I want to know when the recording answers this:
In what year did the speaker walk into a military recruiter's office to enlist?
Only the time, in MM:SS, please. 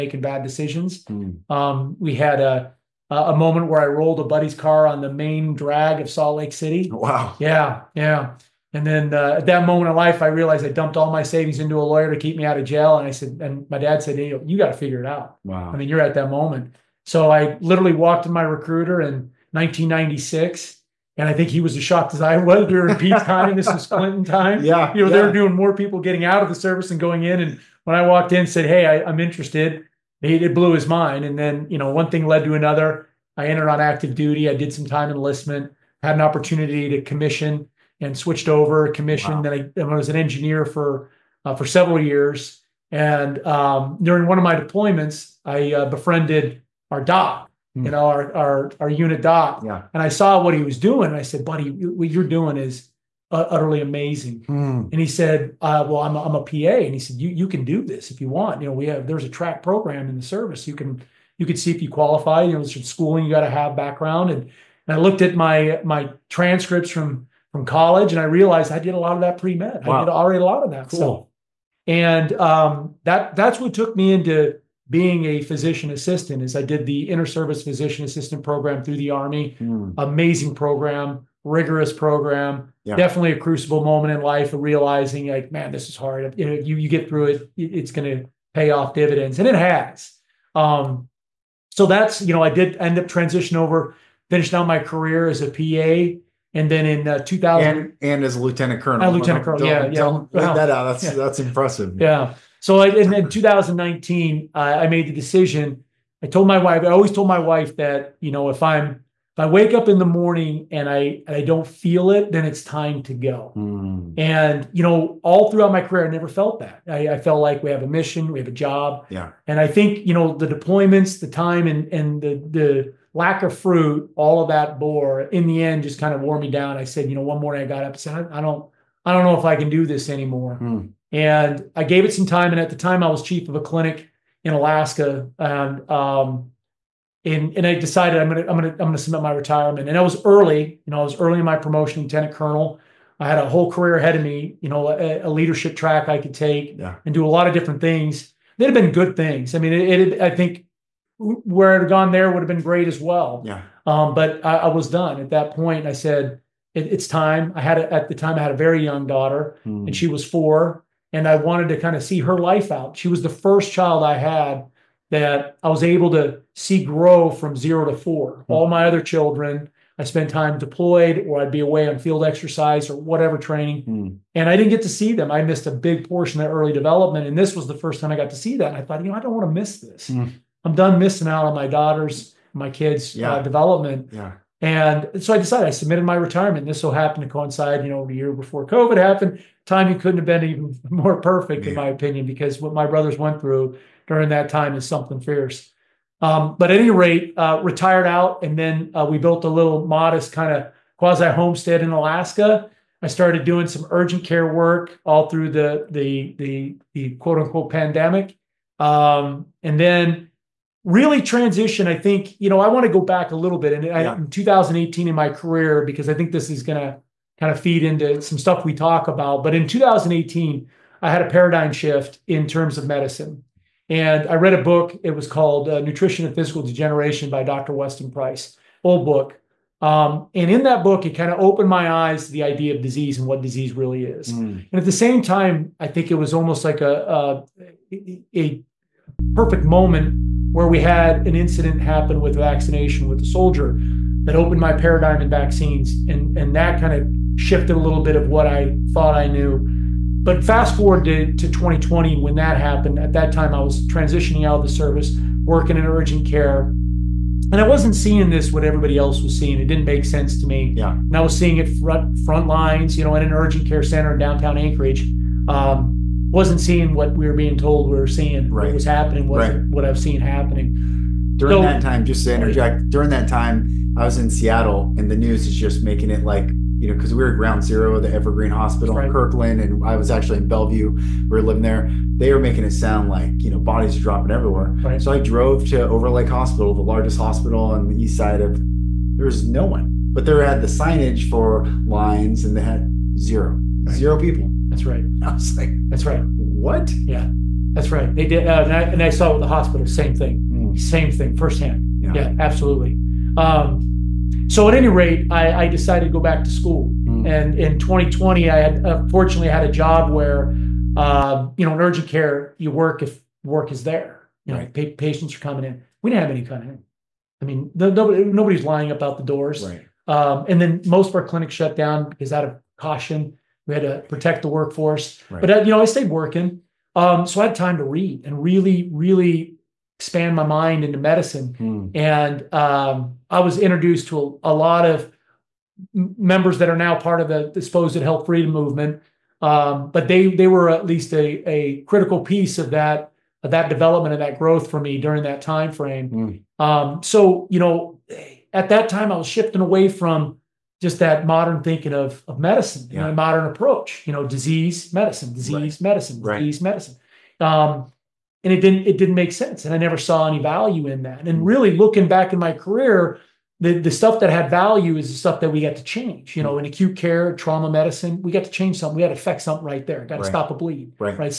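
00:19.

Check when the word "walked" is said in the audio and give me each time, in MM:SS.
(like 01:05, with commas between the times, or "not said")
00:17, 00:28.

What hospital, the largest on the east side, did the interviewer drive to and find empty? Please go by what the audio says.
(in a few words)
Overlake Hospital.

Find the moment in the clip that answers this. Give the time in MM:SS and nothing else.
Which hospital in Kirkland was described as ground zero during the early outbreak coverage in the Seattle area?
04:38.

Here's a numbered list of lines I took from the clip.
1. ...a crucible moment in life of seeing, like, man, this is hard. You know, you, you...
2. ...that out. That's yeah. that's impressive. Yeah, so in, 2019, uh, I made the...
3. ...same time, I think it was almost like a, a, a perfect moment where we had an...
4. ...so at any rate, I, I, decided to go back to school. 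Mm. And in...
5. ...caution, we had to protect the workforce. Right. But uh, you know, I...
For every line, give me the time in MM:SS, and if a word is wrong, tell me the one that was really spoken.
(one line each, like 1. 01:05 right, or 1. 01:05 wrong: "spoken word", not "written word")
1. 01:23 wrong: "realizing", not "seeing"
2. 01:40 right
3. 03:54 right
4. 05:04 right
5. 05:22 right.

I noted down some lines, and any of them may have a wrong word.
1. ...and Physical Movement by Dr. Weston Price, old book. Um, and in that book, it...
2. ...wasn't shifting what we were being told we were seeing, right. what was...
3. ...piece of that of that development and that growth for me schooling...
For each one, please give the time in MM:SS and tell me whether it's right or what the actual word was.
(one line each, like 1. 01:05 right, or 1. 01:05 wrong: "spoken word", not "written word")
1. 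03:46 wrong: "Degeneration", not "Movement"
2. 04:26 wrong: "seeing", not "shifting"
3. 05:42 wrong: "during", not "schooling".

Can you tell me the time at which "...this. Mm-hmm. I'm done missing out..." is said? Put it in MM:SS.
02:59.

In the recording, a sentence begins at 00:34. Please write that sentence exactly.
I did some time enlistment, had an opportunity to commission and switched over, commissioned.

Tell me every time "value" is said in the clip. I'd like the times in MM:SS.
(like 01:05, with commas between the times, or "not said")
06:00, 06:04.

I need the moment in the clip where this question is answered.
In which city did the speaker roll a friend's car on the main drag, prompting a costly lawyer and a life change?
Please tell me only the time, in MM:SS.
00:06.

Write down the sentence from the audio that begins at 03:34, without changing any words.
I, in 2018 in my career because I think this is going to kind of feed into some stuff we talk about.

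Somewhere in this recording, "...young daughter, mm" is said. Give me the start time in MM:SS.
02:38.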